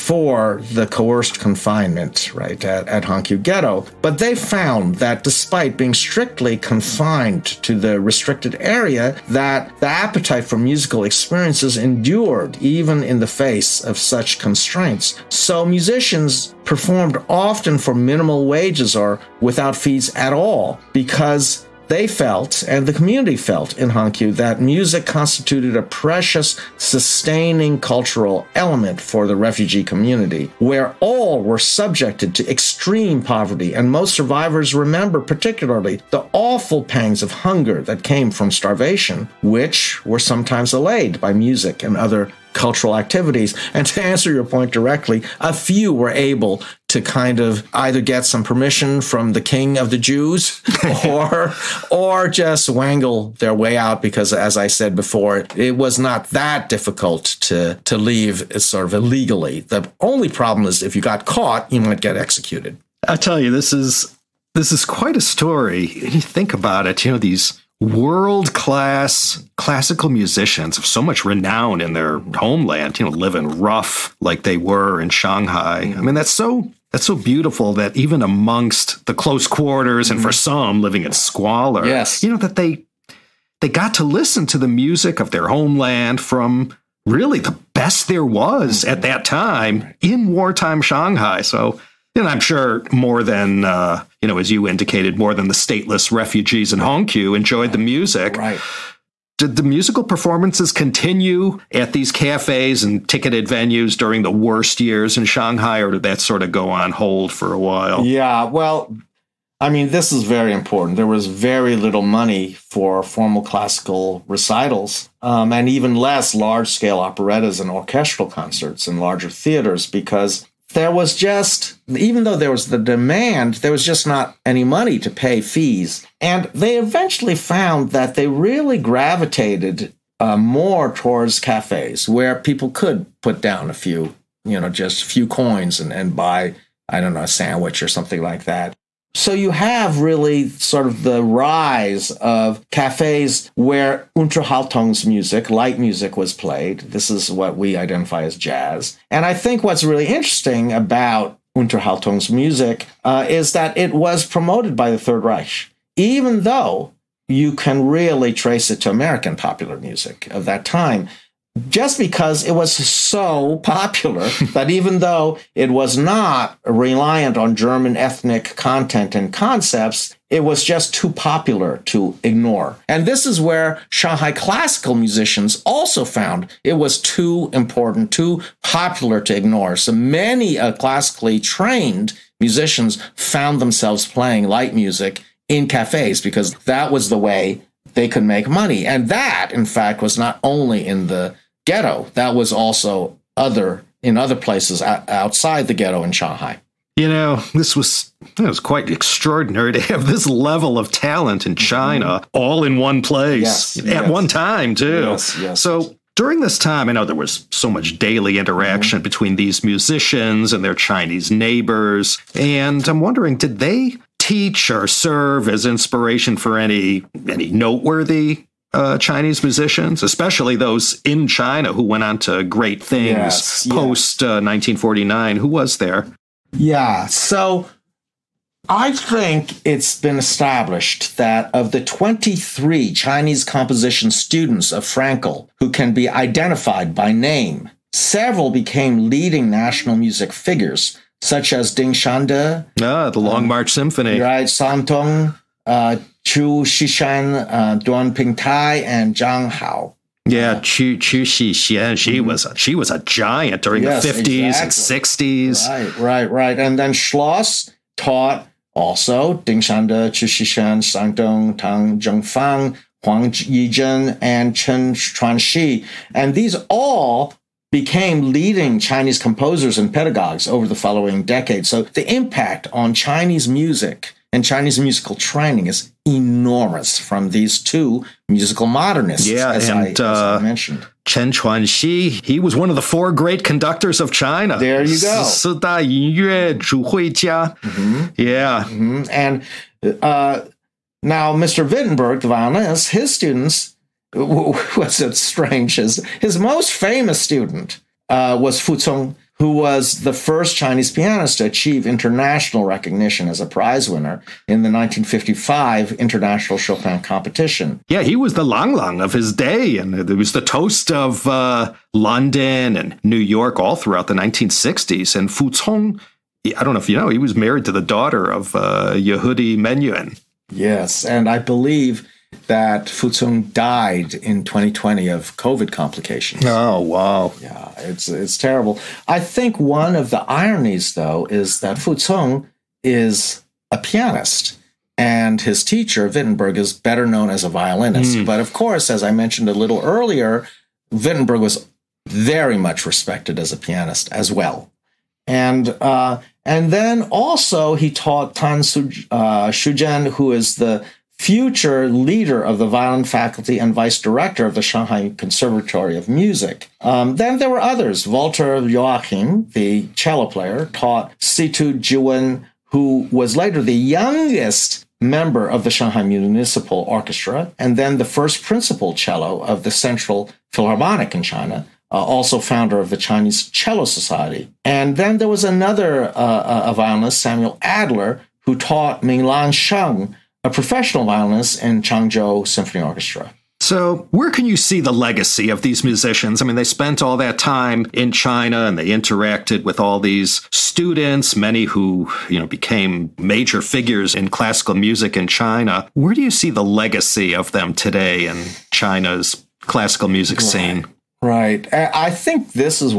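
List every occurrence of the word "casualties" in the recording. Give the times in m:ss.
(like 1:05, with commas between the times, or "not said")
not said.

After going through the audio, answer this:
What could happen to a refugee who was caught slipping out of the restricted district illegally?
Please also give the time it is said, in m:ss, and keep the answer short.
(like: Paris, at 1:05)
executed, at 1:02.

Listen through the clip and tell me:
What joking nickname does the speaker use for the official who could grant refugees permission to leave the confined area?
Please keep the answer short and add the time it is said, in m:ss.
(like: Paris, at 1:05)
the king of the Jews, at 0:49.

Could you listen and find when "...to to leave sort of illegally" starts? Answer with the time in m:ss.
0:57.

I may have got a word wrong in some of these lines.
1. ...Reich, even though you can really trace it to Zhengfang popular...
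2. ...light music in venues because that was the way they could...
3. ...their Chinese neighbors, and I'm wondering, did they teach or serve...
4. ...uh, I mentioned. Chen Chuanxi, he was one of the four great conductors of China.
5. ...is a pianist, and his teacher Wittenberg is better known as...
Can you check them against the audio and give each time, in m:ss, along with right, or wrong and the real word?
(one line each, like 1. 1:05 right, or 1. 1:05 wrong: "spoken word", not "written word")
1. 2:35 wrong: "American", not "Zhengfang"
2. 3:04 wrong: "cafes", not "venues"
3. 3:30 right
4. 4:40 right
5. 5:32 right.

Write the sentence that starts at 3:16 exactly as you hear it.
You know, this was it was quite extraordinary to have this level of talent in China mm -hmm.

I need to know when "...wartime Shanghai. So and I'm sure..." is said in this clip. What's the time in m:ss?
1:30.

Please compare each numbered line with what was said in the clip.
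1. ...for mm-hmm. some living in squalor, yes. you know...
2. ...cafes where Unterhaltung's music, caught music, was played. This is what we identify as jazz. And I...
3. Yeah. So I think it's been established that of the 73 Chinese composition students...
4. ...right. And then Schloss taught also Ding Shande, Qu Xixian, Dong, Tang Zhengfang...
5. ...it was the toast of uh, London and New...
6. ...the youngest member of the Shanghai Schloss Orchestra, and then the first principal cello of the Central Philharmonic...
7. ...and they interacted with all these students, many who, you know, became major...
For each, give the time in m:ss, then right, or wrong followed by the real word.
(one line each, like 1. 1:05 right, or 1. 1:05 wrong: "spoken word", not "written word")
1. 1:20 right
2. 2:22 wrong: "light", not "caught"
3. 3:46 wrong: "23", not "73"
4. 4:16 right
5. 5:10 right
6. 6:03 wrong: "Municipal", not "Schloss"
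7. 6:28 right.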